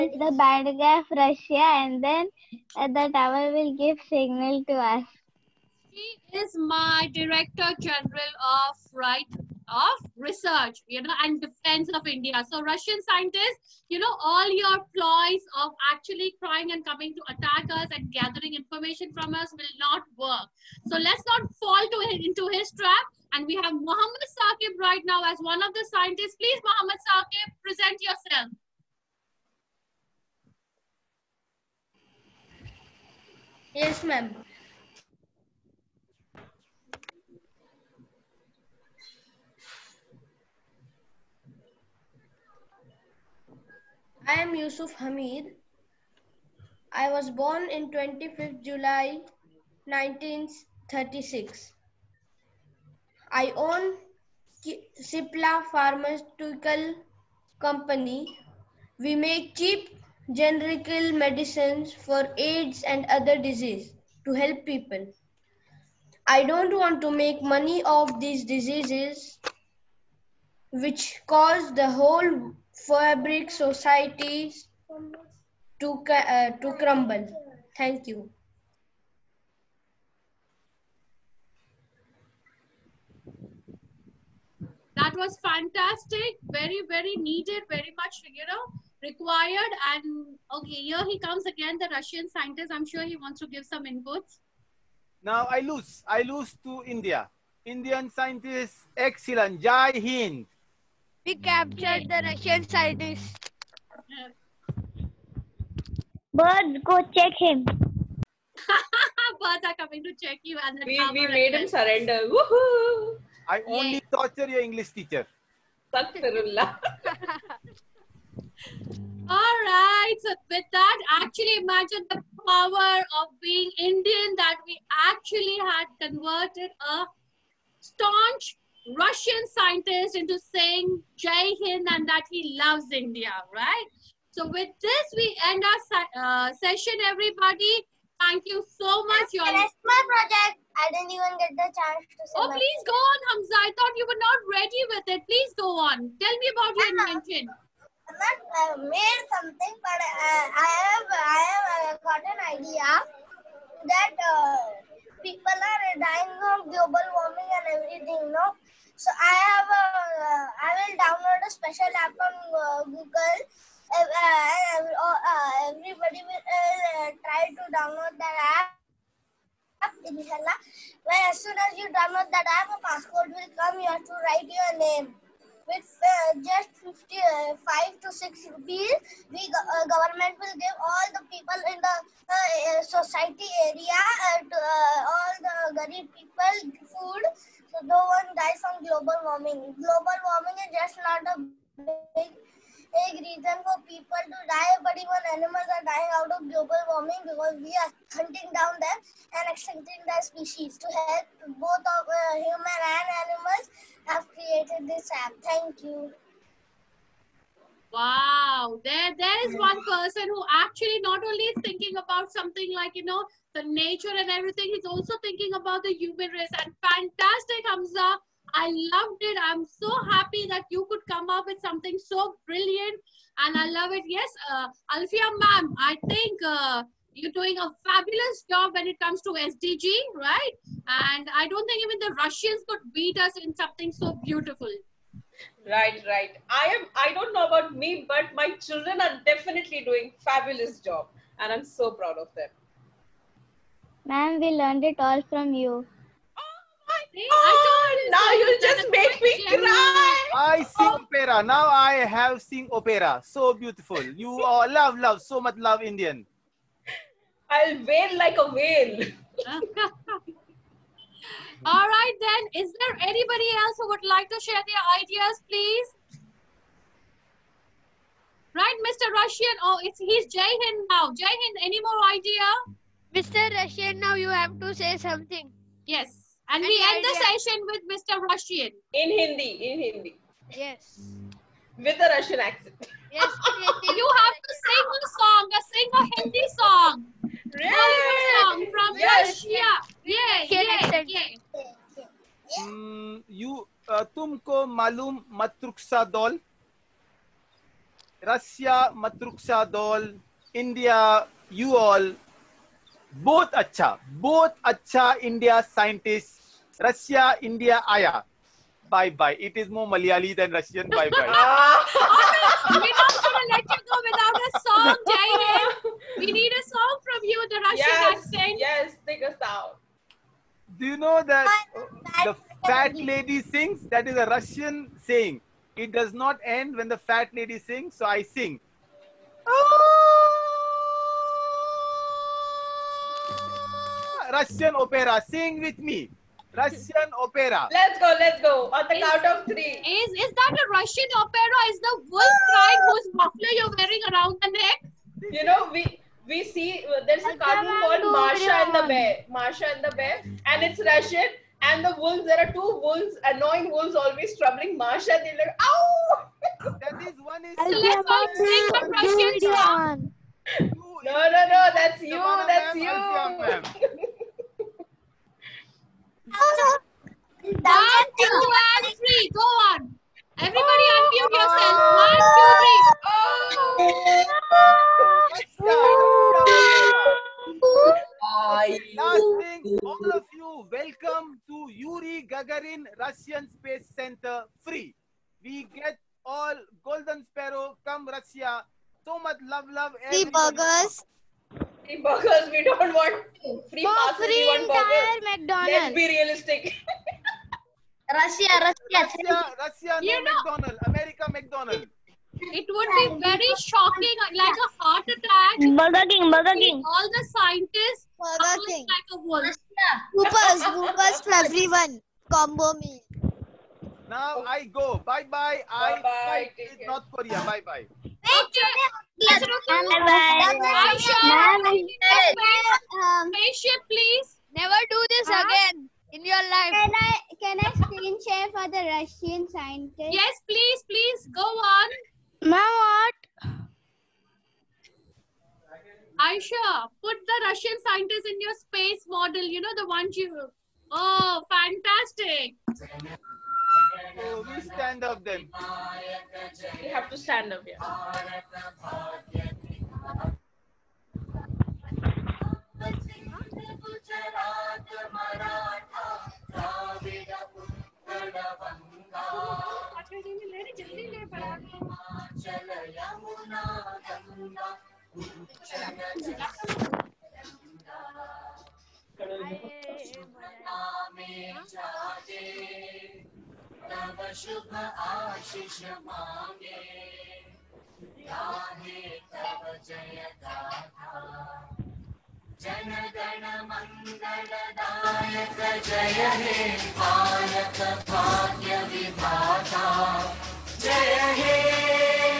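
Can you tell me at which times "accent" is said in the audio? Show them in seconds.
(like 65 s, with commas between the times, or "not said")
282 s, 318 s.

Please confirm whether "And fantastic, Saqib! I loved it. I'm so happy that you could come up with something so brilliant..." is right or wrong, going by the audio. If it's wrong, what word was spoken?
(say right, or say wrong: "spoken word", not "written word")
wrong: "Hamza", not "Saqib".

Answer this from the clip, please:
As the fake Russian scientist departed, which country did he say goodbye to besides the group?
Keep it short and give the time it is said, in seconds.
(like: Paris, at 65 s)
North Korea, at 416 s.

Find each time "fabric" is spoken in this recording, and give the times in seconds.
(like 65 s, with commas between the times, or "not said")
72 s.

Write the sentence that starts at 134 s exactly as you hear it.
So with this, we end our uh, session, everybody.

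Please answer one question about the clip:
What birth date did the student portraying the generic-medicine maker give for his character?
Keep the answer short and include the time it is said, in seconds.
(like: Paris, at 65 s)
25th July 1936, at 47 s.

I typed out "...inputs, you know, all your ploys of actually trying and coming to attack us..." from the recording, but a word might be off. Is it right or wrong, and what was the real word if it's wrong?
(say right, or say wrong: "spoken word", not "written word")
wrong: "scientists", not "inputs".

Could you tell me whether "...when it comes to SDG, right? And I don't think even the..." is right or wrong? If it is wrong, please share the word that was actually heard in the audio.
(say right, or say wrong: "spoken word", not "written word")
right.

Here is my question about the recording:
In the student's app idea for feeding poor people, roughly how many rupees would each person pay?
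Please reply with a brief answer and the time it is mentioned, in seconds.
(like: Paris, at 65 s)
5 to 6 rupees, at 176 s.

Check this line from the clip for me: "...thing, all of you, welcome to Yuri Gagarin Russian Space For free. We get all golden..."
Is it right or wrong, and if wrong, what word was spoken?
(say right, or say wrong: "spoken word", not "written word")
wrong: "Center", not "For".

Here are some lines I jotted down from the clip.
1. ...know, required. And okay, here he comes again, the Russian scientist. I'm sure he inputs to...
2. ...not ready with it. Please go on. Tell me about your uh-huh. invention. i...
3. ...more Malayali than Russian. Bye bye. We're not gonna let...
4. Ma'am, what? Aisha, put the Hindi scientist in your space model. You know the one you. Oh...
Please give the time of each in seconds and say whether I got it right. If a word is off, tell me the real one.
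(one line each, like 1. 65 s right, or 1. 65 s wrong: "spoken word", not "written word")
1. 88 s wrong: "wants", not "inputs"
2. 144 s right
3. 309 s right
4. 432 s wrong: "Russian", not "Hindi".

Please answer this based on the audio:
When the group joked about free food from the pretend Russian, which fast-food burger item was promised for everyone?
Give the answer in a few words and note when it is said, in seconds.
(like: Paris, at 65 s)
Whoppers, at 410 s.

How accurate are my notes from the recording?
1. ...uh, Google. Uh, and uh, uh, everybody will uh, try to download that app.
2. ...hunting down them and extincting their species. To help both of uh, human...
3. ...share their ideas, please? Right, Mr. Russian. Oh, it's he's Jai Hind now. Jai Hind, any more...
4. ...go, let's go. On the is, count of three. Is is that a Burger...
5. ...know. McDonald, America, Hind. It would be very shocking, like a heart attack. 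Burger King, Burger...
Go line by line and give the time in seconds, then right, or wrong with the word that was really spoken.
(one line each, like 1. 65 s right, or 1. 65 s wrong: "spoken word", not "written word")
1. 162 s right
2. 198 s right
3. 264 s right
4. 337 s wrong: "Russian", not "Burger"
5. 400 s wrong: "McDonald", not "Hind".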